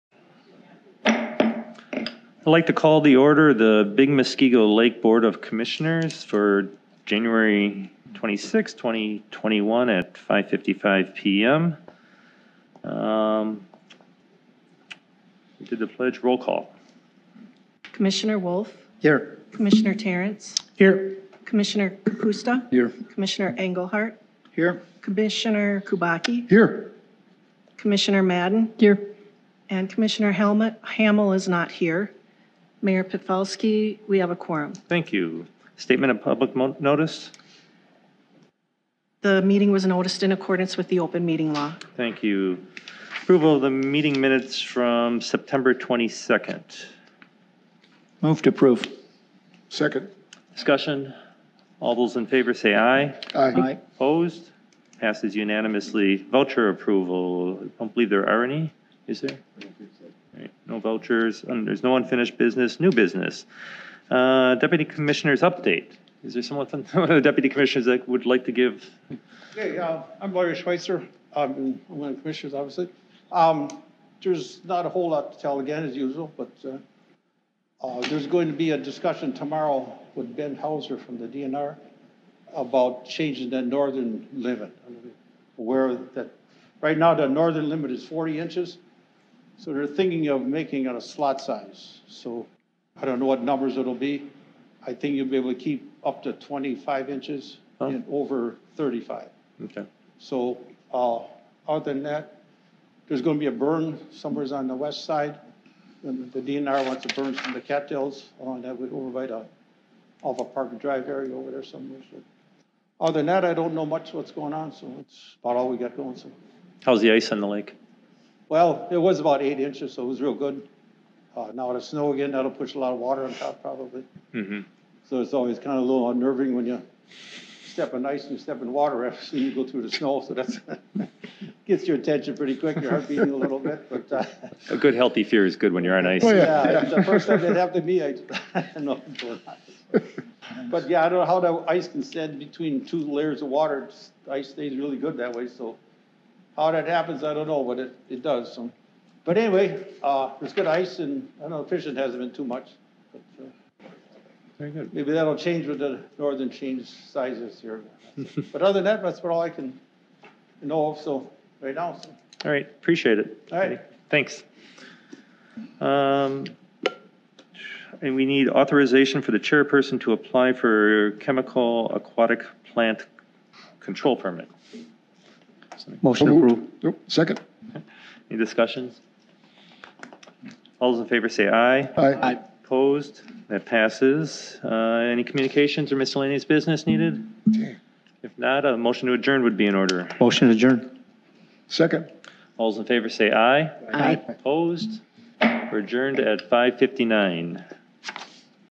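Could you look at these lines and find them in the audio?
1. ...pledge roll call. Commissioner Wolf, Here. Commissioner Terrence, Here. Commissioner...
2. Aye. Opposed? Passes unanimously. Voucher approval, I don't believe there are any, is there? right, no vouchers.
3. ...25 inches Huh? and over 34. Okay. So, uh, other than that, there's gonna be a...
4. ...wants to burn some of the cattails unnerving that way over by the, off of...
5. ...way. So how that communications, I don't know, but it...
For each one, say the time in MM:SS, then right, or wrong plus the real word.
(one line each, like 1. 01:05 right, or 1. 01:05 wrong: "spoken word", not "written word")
1. 00:15 right
2. 00:53 right
3. 01:36 wrong: "35", not "34"
4. 01:46 wrong: "along", not "unnerving"
5. 02:25 wrong: "happens", not "communications".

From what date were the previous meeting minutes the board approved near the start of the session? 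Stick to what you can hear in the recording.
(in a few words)
September 22.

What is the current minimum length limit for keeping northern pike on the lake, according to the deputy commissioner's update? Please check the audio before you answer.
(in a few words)
40 inches.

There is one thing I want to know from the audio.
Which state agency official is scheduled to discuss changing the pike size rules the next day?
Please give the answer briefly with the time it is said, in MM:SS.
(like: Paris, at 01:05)
Ben Hauser, at 01:20.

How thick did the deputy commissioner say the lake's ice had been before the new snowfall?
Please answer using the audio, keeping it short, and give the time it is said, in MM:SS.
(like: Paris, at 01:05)
8 inches, at 01:59.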